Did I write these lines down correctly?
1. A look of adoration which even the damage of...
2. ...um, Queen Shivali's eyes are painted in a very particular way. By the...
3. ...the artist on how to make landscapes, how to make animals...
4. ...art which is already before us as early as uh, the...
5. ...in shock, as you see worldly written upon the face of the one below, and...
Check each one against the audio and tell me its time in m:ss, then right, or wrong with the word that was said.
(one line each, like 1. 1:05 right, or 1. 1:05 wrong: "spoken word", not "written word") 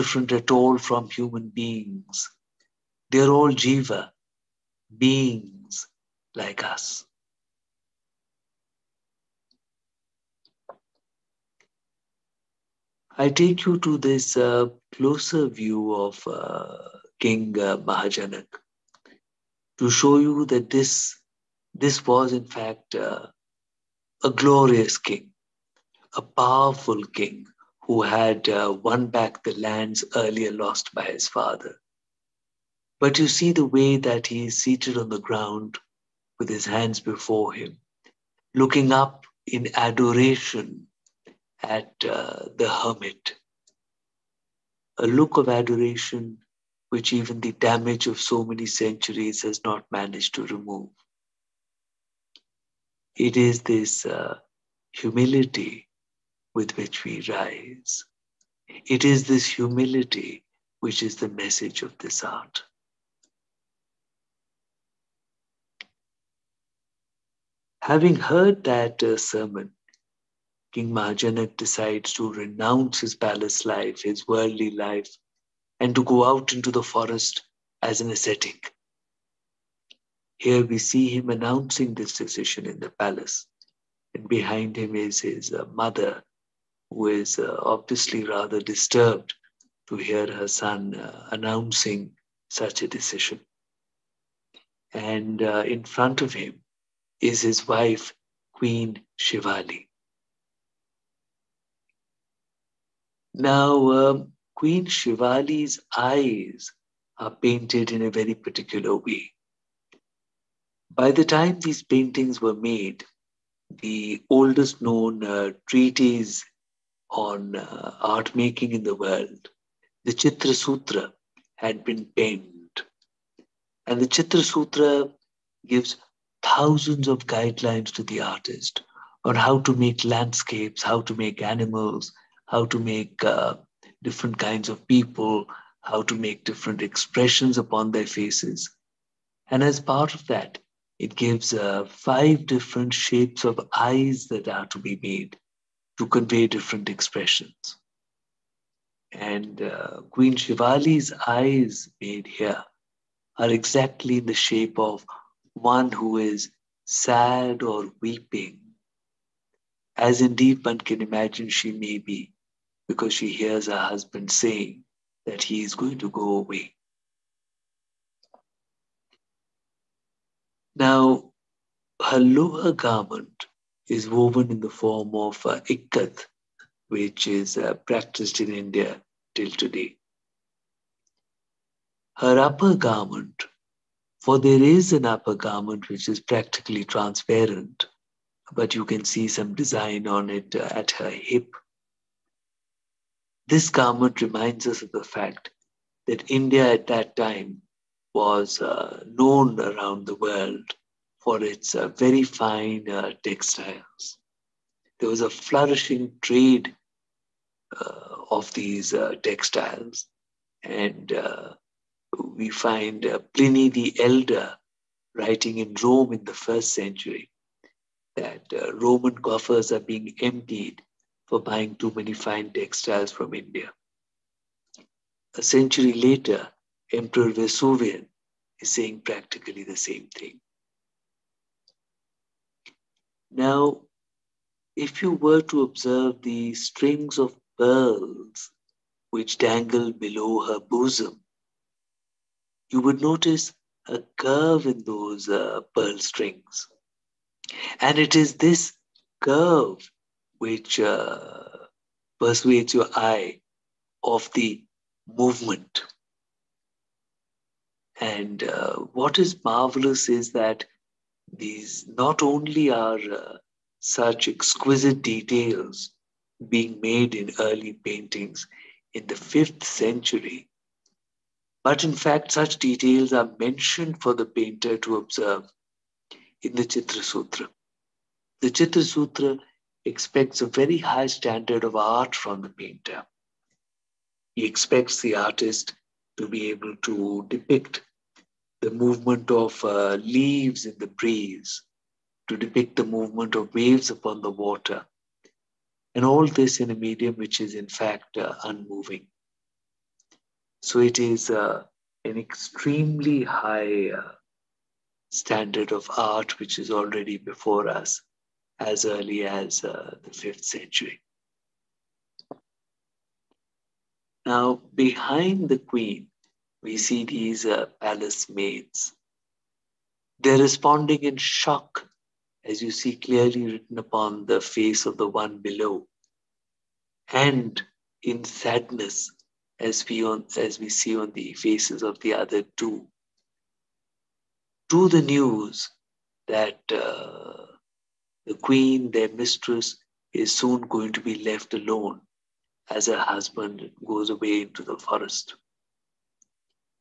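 1. 0:44 right
2. 1:43 right
3. 2:08 right
4. 5:05 right
5. 5:21 wrong: "clearly", not "worldly".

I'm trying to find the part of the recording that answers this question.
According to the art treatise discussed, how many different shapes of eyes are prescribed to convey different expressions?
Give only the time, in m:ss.
2:21.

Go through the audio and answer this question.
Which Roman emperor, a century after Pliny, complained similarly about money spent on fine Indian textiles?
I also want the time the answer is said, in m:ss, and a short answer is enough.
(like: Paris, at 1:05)
Vespasian, at 3:46.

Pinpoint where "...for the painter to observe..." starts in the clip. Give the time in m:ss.
4:34.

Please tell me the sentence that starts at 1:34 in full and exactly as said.
And in front of him is his wife, Queen Shivali.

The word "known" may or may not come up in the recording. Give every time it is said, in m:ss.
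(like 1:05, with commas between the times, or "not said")
1:54, 3:19.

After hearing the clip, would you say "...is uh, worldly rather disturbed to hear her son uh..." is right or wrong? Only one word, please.
wrong.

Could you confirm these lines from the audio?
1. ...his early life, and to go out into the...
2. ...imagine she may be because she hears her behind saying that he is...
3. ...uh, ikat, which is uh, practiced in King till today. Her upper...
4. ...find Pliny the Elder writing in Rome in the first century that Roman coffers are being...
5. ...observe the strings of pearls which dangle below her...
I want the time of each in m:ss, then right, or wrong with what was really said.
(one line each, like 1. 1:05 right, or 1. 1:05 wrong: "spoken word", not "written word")
1. 1:14 wrong: "worldly", not "early"
2. 2:40 wrong: "husband", not "behind"
3. 2:55 wrong: "India", not "King"
4. 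3:32 right
5. 3:55 right.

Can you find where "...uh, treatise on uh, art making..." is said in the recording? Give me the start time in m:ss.
1:55.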